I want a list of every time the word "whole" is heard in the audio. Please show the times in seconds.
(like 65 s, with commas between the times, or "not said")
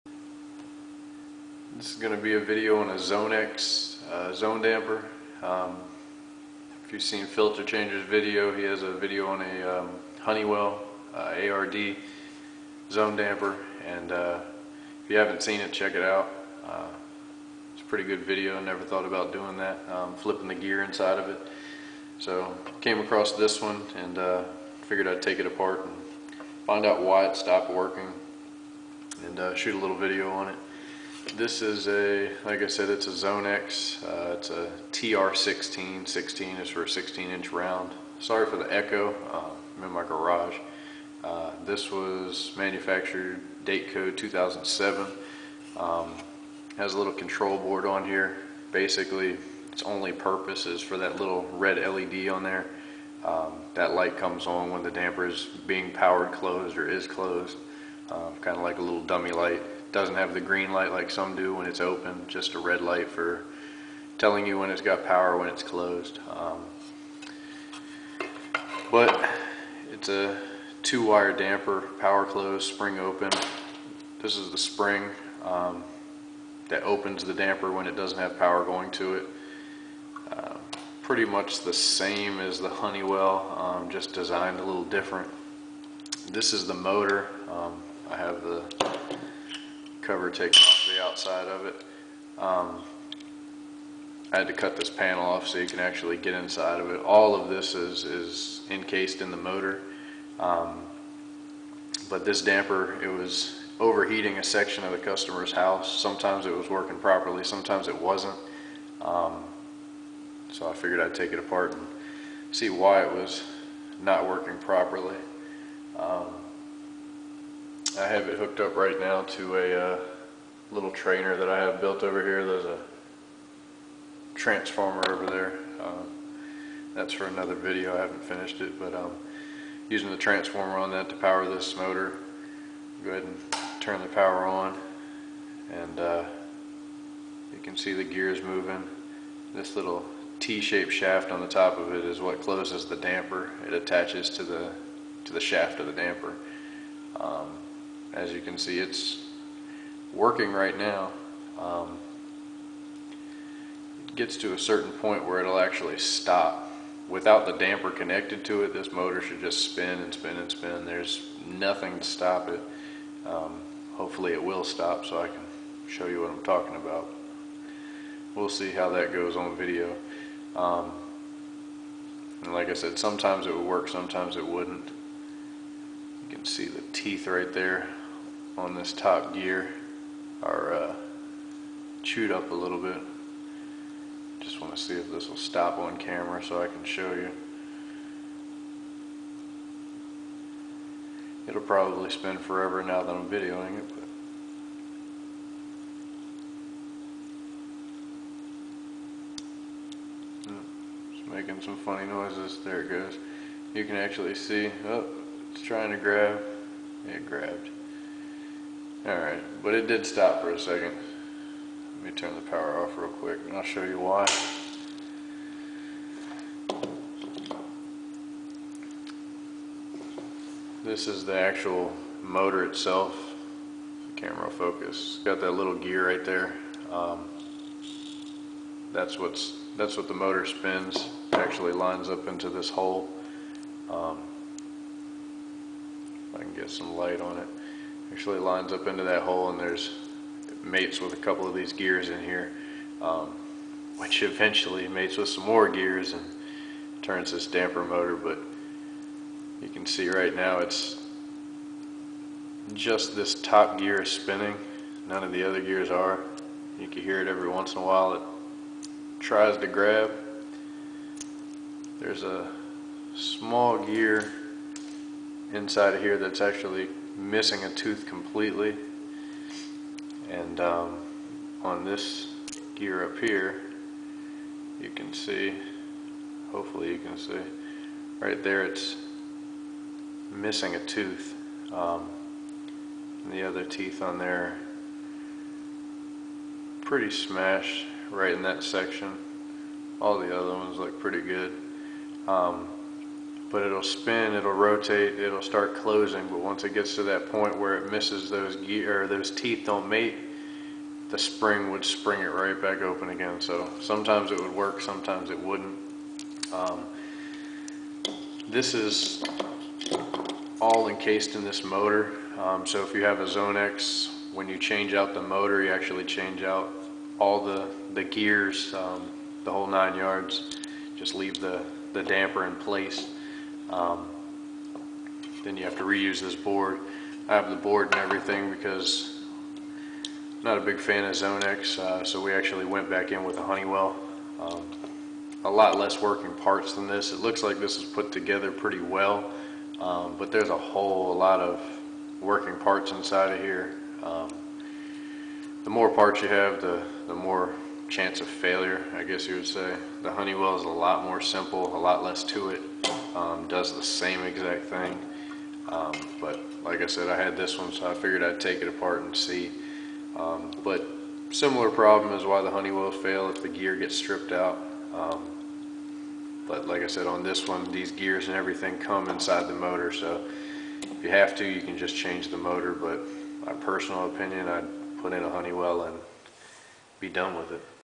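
319 s, 340 s.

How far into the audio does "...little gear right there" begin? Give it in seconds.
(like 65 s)
225 s.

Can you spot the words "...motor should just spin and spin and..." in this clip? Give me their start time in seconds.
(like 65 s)
158 s.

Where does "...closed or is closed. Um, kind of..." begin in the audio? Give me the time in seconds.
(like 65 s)
56 s.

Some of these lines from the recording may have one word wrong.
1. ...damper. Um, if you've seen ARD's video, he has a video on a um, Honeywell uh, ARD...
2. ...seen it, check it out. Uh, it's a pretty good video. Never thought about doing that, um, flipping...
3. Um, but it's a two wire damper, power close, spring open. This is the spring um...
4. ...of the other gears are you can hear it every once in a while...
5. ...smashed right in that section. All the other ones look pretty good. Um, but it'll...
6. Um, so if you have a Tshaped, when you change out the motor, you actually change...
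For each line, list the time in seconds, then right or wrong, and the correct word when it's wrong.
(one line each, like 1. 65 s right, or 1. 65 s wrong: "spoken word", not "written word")
1. 4 s wrong: "Filterchanger", not "ARD"
2. 15 s right
3. 66 s right
4. 255 s right
5. 287 s right
6. 312 s wrong: "Zonex", not "Tshaped".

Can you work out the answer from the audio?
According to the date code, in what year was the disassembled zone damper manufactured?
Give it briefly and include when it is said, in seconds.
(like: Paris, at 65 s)
2007, at 44 s.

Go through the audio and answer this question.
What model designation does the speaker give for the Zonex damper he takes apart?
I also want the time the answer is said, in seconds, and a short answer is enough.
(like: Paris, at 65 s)
TR16, at 34 s.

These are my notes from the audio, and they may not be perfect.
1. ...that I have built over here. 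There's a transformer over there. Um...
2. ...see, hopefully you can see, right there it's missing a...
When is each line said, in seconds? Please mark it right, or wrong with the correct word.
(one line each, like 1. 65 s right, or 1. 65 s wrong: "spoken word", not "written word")
1. 121 s right
2. 275 s right.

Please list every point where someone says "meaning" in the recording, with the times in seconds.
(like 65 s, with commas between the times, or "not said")
not said.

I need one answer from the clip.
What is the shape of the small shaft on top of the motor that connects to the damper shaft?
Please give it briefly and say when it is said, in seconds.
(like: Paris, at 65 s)
T-shaped, at 140 s.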